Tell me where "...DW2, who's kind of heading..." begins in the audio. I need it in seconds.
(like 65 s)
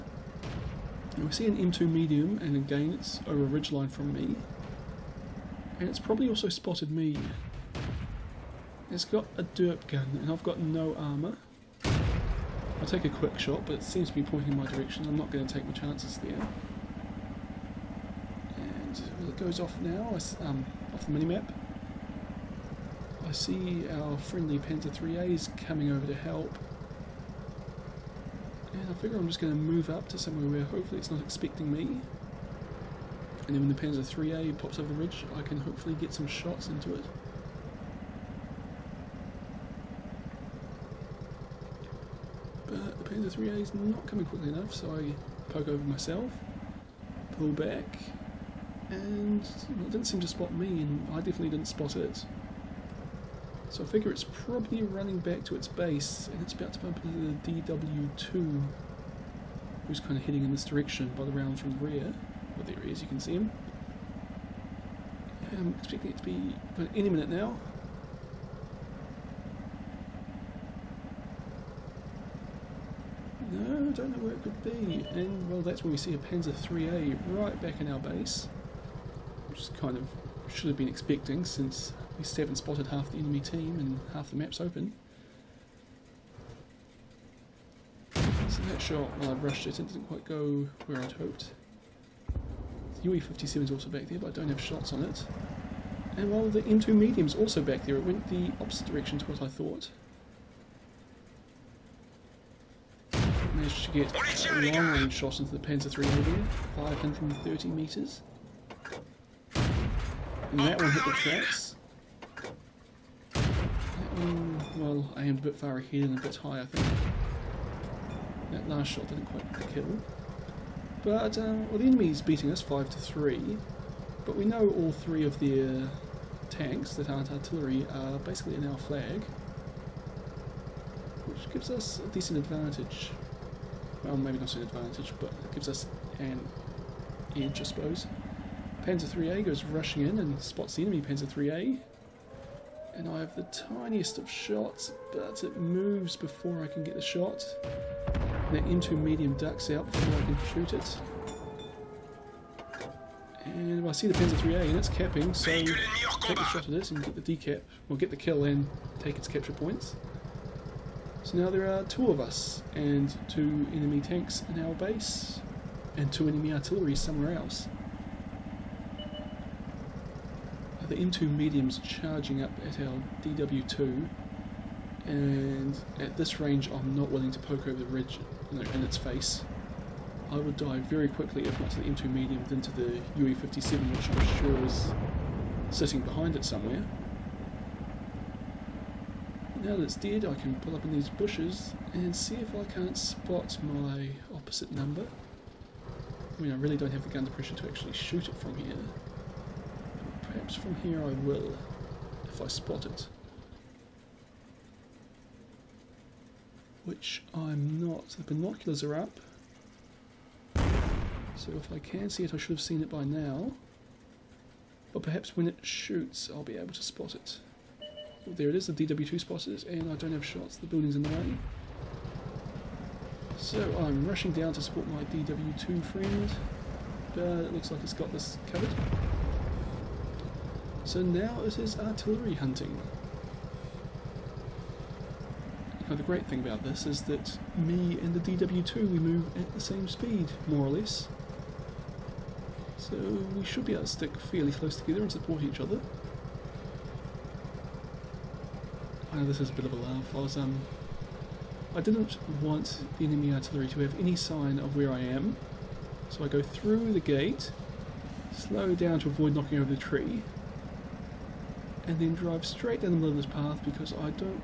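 57 s.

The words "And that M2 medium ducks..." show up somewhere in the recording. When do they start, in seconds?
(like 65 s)
148 s.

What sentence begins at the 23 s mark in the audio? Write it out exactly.
I see our friendly Panzer 3As coming over to help.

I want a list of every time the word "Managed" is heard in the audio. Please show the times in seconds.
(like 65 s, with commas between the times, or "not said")
103 s.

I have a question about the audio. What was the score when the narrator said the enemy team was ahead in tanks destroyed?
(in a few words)
5 to 3.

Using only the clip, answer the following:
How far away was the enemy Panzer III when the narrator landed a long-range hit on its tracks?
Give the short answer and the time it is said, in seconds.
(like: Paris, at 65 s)
530 metres, at 106 s.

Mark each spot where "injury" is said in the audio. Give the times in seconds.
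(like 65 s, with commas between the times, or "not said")
not said.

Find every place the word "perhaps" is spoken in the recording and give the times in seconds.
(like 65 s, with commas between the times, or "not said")
200 s, 215 s.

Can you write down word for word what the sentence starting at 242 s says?
So we should be able to stick fairly close together and support each other.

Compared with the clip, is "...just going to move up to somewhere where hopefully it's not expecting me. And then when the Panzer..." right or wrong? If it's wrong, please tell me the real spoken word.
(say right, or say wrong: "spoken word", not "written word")
right.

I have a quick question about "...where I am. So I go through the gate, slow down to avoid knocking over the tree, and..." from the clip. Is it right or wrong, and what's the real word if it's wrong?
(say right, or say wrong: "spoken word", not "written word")
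right.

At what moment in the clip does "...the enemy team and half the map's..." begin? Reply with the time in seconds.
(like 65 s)
83 s.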